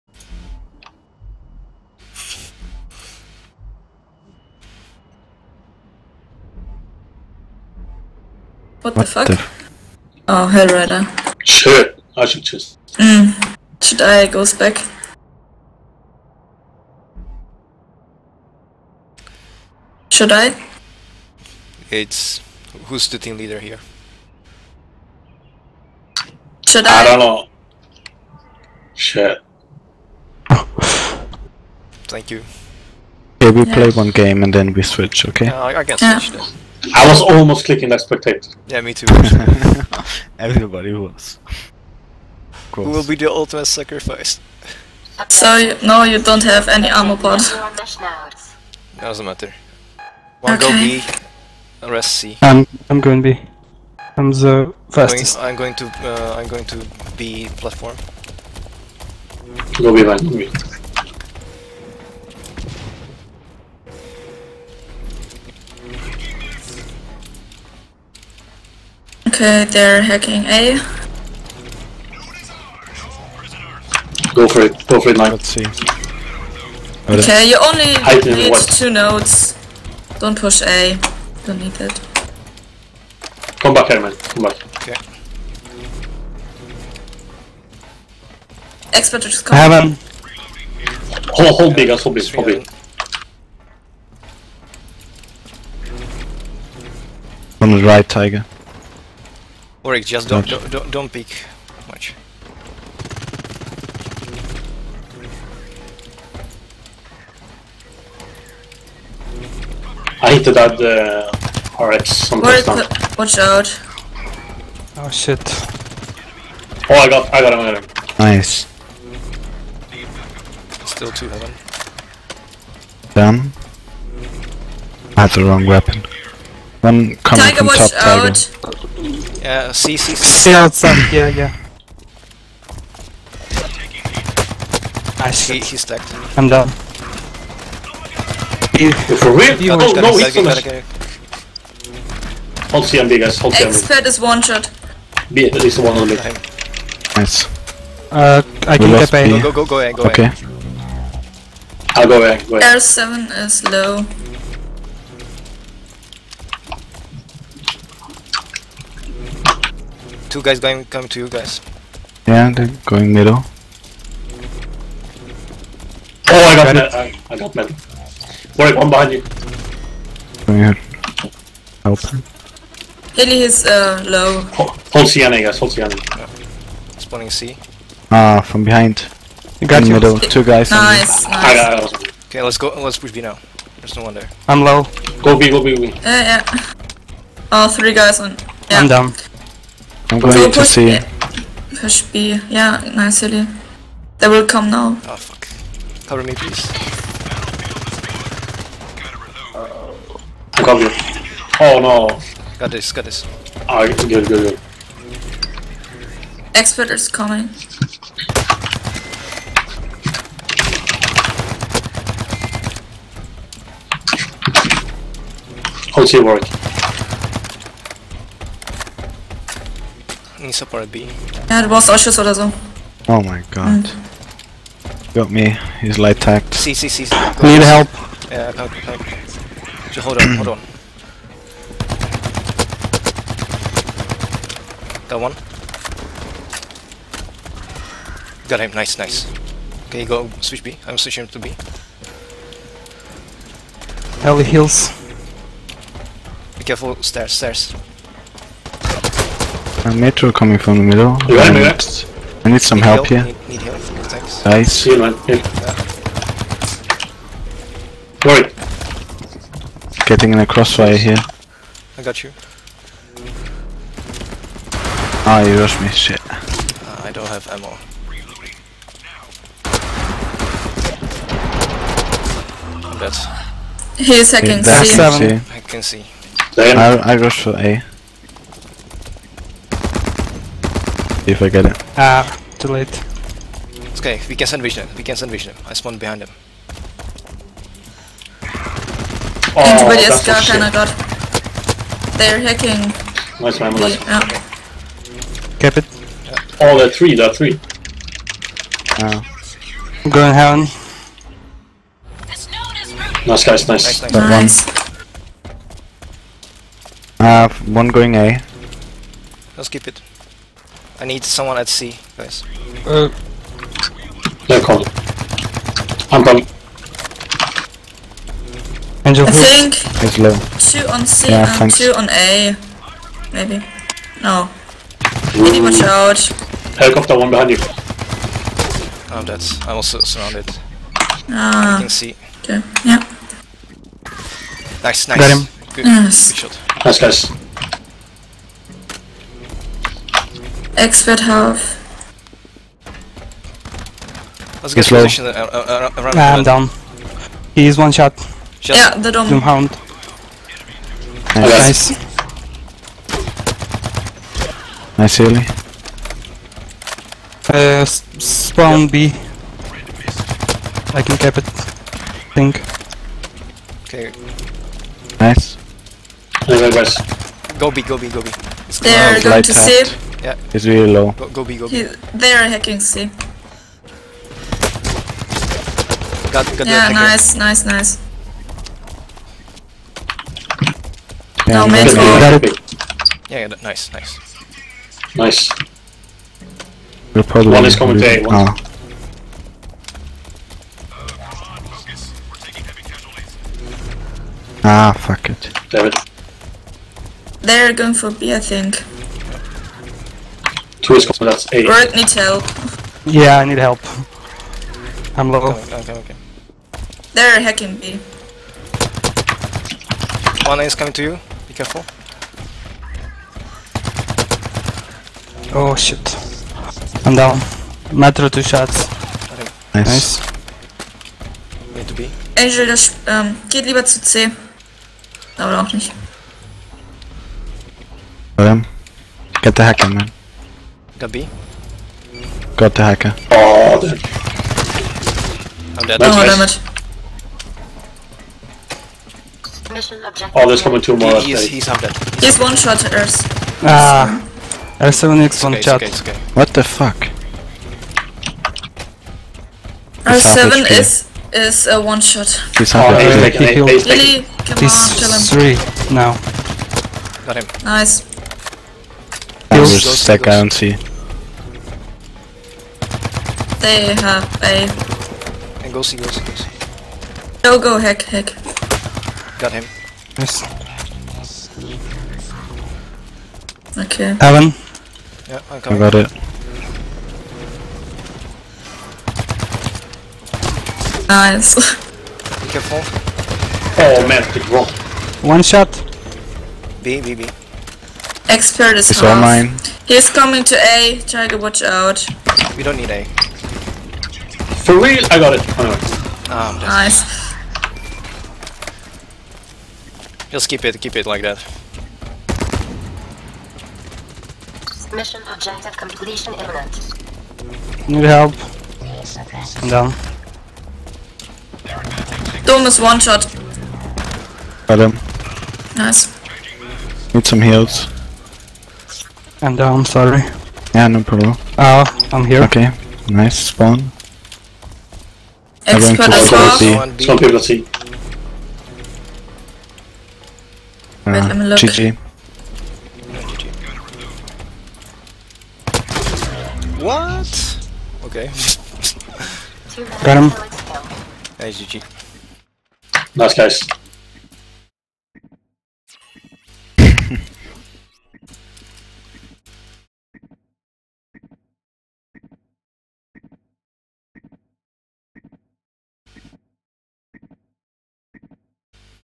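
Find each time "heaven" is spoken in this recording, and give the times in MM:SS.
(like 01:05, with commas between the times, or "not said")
02:01, 05:00.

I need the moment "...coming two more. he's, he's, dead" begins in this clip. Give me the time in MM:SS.
07:20.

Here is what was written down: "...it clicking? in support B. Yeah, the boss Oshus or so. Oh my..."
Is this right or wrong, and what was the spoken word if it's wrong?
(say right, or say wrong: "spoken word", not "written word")
wrong: "working", not "clicking".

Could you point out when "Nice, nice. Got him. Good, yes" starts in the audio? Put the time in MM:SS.
05:34.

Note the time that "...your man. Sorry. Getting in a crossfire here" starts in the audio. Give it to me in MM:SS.
04:14.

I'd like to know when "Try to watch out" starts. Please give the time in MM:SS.
08:11.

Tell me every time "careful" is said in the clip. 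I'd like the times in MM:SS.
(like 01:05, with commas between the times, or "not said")
04:06, 06:51, 08:02.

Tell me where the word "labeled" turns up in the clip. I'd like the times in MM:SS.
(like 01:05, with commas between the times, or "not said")
not said.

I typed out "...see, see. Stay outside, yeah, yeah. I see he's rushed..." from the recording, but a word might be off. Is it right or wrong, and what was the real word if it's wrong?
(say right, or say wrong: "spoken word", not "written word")
wrong: "stacked", not "rushed".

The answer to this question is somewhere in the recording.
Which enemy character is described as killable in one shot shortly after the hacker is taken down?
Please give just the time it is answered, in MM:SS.
07:24.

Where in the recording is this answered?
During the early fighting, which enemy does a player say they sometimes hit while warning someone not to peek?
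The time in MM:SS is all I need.
01:51.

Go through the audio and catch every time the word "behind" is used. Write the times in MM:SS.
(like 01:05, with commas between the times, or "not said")
02:48, 02:58, 04:45, 05:27.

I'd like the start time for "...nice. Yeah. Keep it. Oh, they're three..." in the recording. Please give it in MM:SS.
04:53.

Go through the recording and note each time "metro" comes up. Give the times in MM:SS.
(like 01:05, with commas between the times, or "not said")
04:09, 06:57.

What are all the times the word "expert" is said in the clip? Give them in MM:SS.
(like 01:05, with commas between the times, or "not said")
01:28, 02:23, 03:26, 05:40, 08:08, 08:45.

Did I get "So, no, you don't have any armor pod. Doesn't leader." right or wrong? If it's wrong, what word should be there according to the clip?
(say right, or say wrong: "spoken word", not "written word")
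wrong: "matter", not "leader".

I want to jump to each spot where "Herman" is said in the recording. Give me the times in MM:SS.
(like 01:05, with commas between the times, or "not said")
01:23.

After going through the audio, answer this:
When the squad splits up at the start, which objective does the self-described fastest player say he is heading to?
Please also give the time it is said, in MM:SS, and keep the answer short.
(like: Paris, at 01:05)
B platform, at 00:57.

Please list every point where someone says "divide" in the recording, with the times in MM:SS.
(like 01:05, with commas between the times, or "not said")
not said.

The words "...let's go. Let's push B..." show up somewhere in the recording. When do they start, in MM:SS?
03:02.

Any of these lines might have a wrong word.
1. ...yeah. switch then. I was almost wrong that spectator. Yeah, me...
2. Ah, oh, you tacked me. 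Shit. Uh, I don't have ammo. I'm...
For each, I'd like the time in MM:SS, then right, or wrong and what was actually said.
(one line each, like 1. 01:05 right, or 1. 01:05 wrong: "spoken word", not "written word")
1. 00:36 wrong: "clicking", not "wrong"
2. 04:25 wrong: "rushed", not "tacked".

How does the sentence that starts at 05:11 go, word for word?
I need someone at C, guys.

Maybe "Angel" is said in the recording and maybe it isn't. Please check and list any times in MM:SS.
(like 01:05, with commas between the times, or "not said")
05:19, 07:02.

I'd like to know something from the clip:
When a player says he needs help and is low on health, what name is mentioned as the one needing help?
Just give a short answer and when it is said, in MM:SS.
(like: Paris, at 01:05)
Greg, at 06:41.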